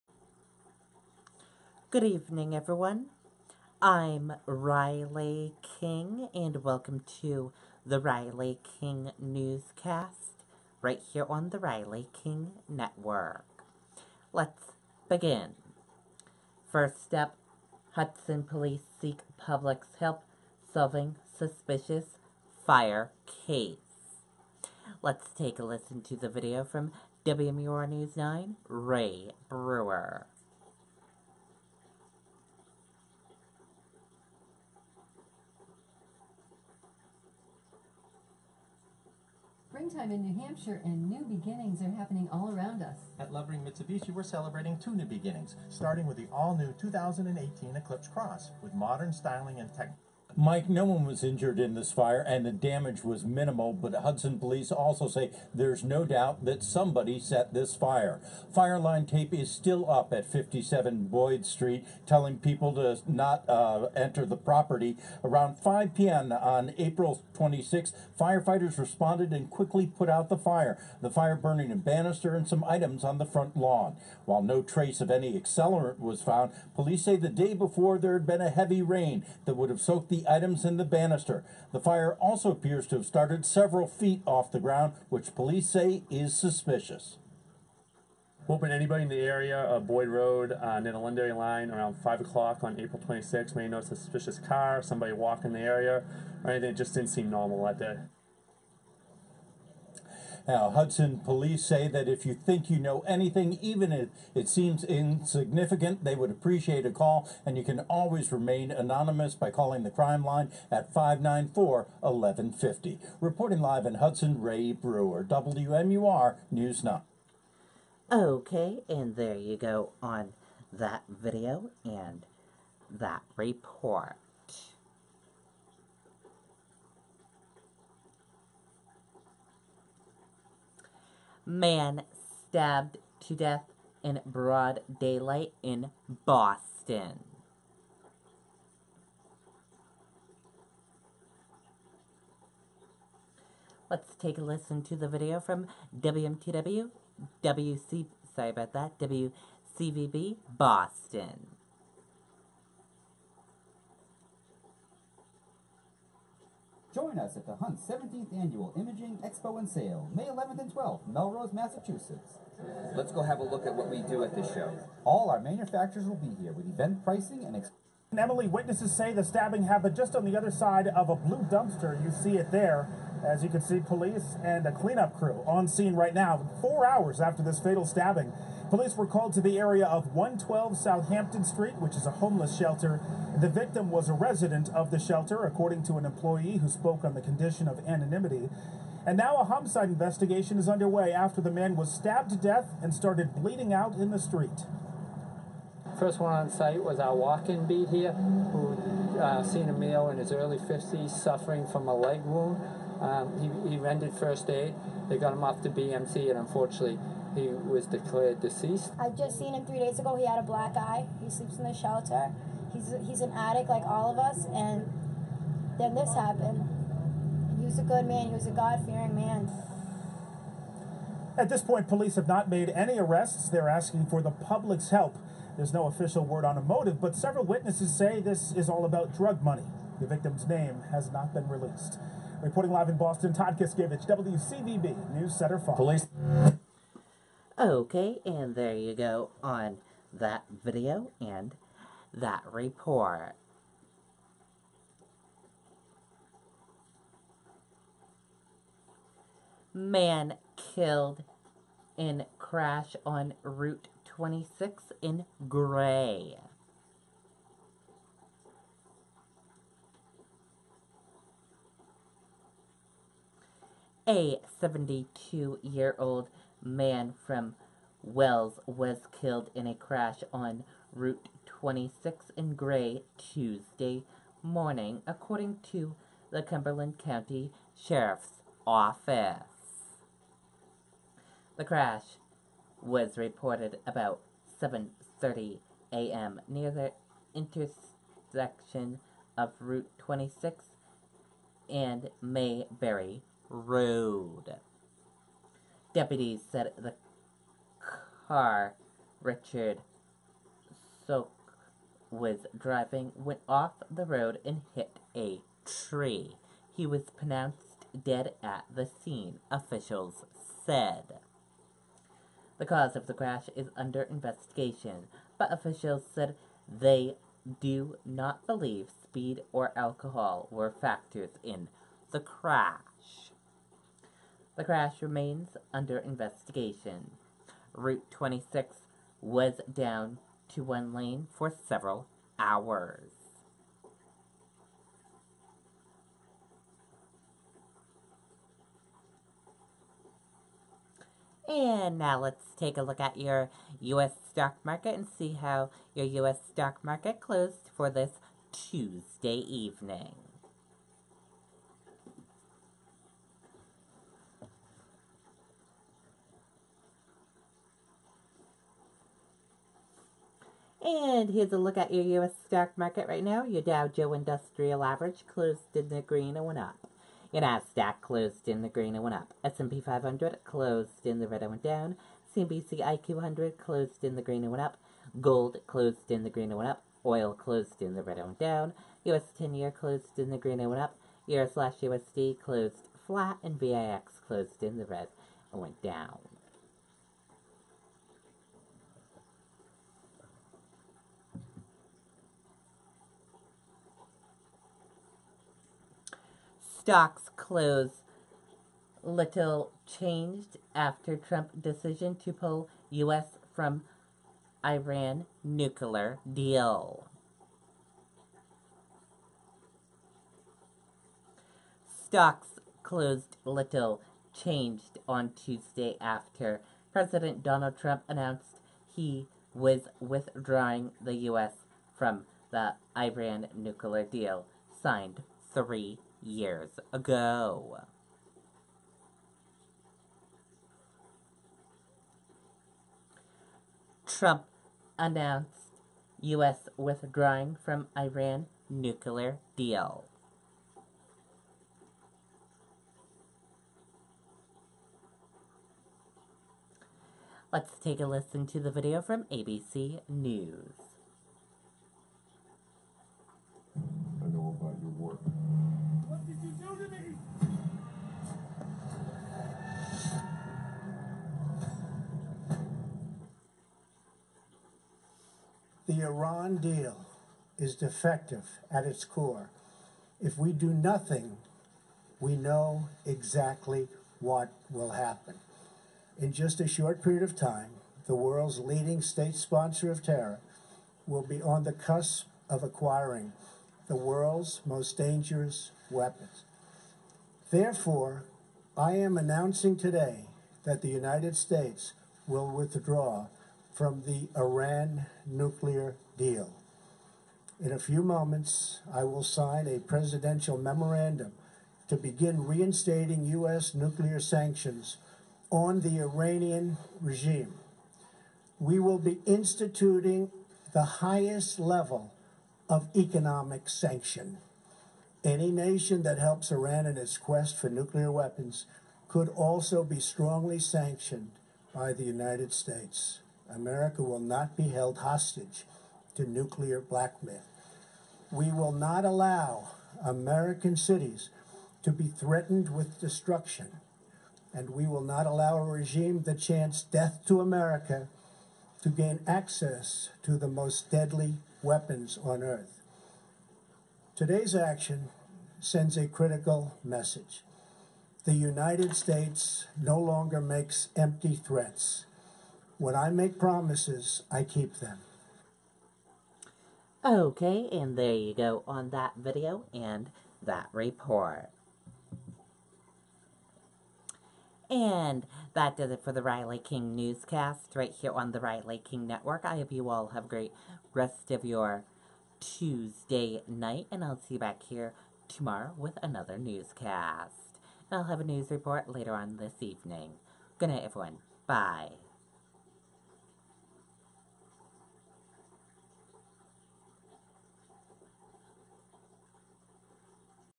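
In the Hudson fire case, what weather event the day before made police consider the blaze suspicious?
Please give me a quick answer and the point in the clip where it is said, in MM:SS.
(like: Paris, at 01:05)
Heavy rain, at 01:18.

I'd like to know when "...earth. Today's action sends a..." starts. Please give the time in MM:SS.
09:02.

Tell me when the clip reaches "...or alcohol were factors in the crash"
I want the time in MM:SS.
05:19.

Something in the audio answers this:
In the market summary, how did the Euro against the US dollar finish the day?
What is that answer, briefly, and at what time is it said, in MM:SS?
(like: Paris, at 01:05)
Flat, at 06:23.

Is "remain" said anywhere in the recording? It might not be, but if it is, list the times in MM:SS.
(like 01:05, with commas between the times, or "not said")
01:48, 05:25.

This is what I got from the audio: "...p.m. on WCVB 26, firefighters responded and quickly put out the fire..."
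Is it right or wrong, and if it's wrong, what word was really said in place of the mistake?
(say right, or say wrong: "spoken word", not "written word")
wrong: "April", not "WCVB".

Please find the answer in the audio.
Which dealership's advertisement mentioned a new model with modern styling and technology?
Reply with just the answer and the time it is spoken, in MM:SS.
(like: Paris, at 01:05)
Lovering Mitsubishi, at 00:43.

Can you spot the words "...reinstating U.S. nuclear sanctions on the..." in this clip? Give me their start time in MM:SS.
08:22.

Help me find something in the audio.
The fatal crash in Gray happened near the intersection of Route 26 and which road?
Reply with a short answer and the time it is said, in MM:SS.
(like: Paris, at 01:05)
Mayberry Road, at 04:52.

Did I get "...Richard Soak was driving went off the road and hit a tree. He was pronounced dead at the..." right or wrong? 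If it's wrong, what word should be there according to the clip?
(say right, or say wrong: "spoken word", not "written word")
right.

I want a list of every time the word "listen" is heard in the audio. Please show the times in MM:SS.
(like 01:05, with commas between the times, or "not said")
00:25, 02:24, 07:28.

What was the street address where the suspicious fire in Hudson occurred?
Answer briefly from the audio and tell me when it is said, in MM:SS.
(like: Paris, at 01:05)
57 Boyd Street, at 01:00.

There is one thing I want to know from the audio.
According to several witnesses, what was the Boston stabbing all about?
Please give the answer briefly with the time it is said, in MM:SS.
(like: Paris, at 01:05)
Drug money, at 03:49.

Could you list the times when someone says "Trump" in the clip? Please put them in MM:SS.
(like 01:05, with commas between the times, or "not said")
06:41, 06:57, 07:14.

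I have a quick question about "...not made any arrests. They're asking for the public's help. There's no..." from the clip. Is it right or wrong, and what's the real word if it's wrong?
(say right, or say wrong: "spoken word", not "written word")
right.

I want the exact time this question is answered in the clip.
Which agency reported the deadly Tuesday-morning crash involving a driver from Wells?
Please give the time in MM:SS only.
04:36.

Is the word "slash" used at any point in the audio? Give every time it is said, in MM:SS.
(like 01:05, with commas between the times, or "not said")
06:21.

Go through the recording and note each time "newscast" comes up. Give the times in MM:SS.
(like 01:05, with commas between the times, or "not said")
00:09, 09:26, 09:36.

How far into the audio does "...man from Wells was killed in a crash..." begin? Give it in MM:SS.
04:26.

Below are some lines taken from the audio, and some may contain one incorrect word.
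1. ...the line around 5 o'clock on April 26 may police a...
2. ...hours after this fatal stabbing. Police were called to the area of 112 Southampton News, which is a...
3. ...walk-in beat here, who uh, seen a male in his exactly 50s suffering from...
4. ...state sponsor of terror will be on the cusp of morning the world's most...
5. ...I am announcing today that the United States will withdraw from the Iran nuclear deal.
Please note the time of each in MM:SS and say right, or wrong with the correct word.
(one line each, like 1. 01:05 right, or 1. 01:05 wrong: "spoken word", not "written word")
1. 01:30 wrong: "notice", not "police"
2. 02:56 wrong: "Street", not "News"
3. 03:17 wrong: "early", not "exactly"
4. 07:59 wrong: "acquiring", not "morning"
5. 08:08 right.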